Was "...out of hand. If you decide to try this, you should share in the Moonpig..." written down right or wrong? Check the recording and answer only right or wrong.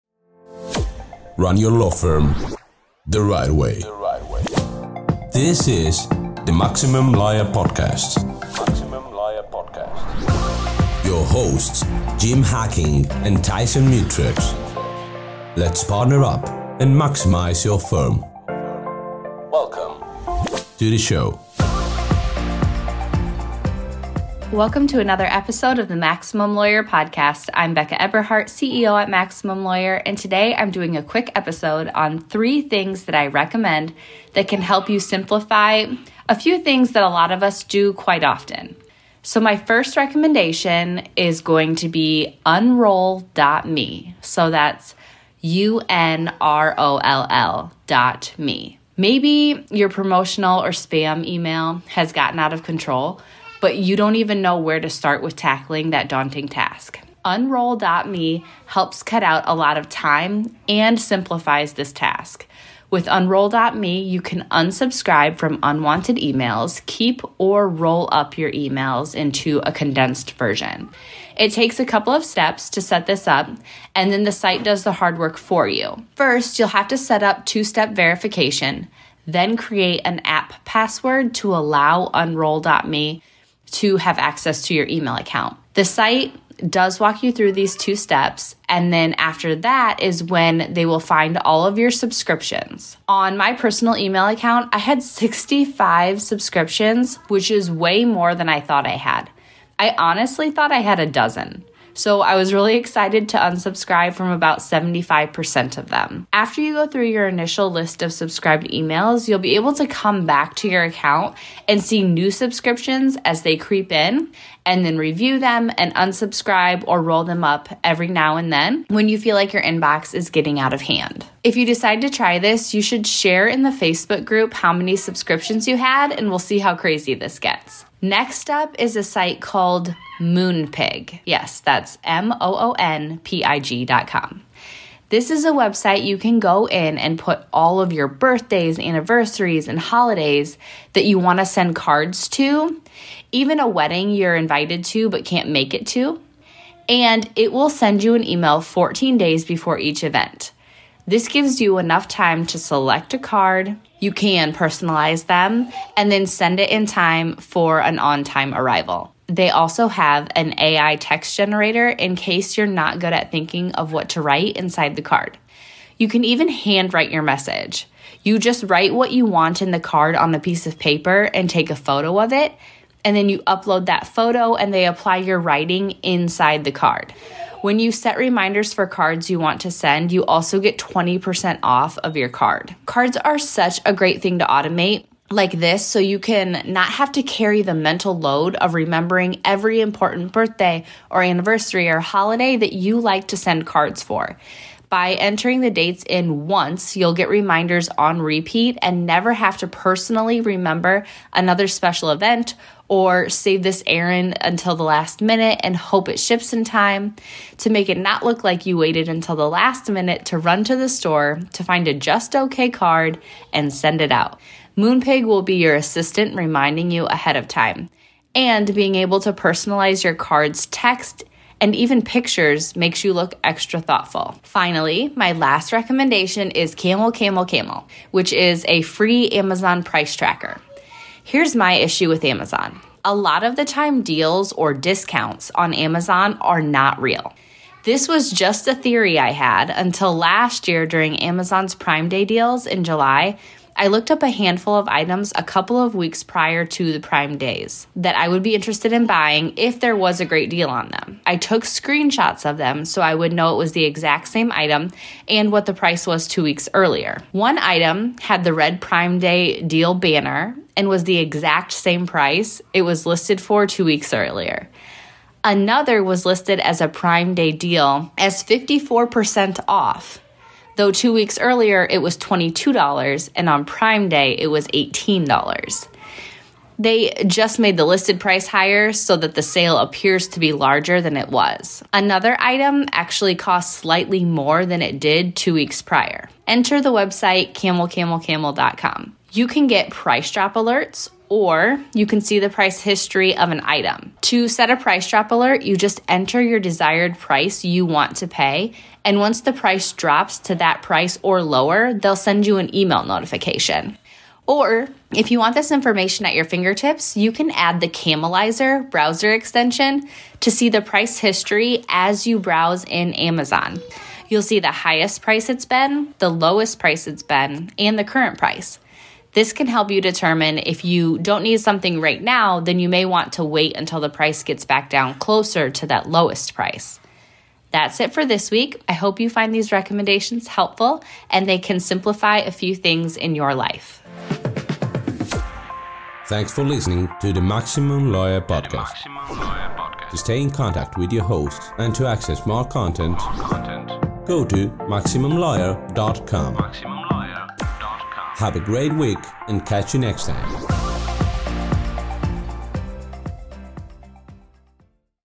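wrong.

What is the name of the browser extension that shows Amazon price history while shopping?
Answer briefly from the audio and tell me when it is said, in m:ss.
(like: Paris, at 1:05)
Camelizer, at 5:07.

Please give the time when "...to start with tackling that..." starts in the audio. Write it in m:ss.
0:54.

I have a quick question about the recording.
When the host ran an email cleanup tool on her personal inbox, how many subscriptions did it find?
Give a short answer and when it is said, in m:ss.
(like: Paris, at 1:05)
65, at 1:35.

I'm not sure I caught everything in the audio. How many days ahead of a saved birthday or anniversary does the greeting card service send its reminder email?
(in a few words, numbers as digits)
14 days.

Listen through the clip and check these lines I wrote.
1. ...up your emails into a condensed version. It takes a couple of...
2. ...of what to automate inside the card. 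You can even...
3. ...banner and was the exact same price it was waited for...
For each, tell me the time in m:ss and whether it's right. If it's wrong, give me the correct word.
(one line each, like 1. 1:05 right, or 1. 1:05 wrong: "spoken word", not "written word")
1. 1:08 right
2. 2:43 wrong: "write", not "automate"
3. 4:19 wrong: "listed", not "waited".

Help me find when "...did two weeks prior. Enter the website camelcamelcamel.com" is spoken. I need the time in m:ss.
4:44.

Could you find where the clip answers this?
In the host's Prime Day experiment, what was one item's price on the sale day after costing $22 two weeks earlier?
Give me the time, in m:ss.
4:34.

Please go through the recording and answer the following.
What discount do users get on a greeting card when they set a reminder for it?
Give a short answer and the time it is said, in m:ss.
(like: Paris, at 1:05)
20% off, at 3:00.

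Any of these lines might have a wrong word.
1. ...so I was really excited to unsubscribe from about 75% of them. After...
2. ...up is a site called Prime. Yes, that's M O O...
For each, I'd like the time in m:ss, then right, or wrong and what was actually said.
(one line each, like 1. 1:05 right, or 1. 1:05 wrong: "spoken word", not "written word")
1. 1:41 right
2. 2:08 wrong: "Moonpig", not "Prime".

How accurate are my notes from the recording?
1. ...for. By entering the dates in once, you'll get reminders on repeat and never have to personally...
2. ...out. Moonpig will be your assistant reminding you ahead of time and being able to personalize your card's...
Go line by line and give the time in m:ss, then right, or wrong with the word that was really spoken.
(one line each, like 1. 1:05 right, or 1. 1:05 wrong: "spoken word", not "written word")
1. 3:14 right
2. 3:34 right.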